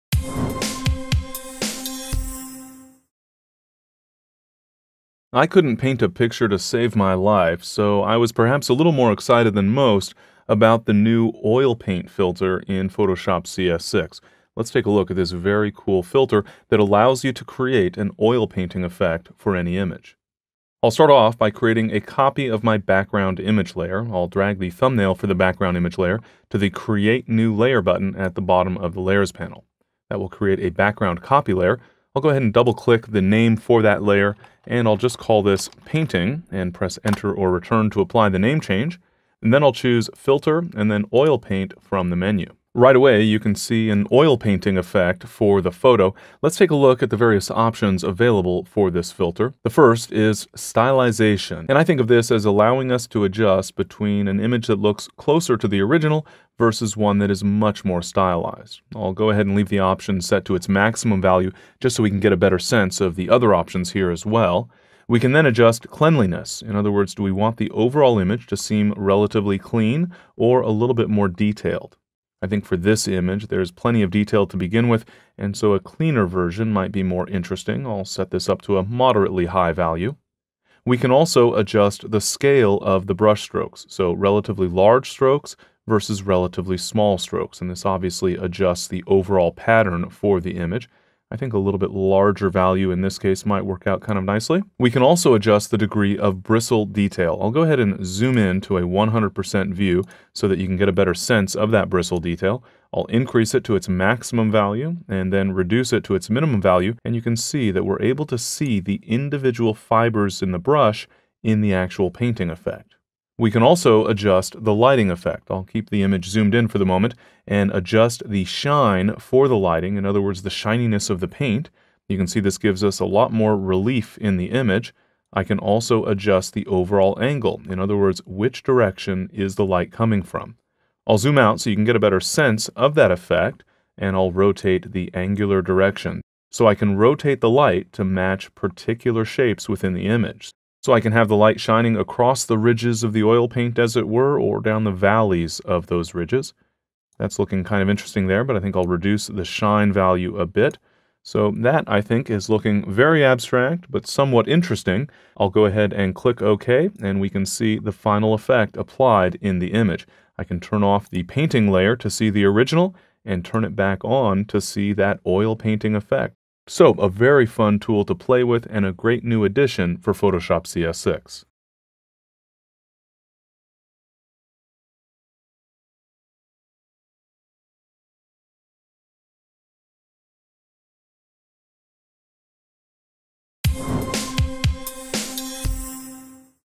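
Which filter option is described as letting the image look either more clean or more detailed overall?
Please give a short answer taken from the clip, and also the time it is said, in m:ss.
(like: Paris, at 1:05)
cleanliness, at 1:05.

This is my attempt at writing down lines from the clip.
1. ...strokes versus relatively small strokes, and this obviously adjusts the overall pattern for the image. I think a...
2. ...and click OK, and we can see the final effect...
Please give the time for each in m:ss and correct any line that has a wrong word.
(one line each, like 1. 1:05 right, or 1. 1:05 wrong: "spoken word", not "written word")
1. 1:25 right
2. 2:35 right.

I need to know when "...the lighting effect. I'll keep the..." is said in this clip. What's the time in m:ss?
1:54.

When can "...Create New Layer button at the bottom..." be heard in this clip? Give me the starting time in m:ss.
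0:26.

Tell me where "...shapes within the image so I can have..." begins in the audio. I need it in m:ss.
2:19.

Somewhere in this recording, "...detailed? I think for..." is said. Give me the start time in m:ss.
1:11.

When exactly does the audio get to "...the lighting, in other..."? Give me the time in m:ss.
1:59.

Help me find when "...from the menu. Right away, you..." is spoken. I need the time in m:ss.
0:41.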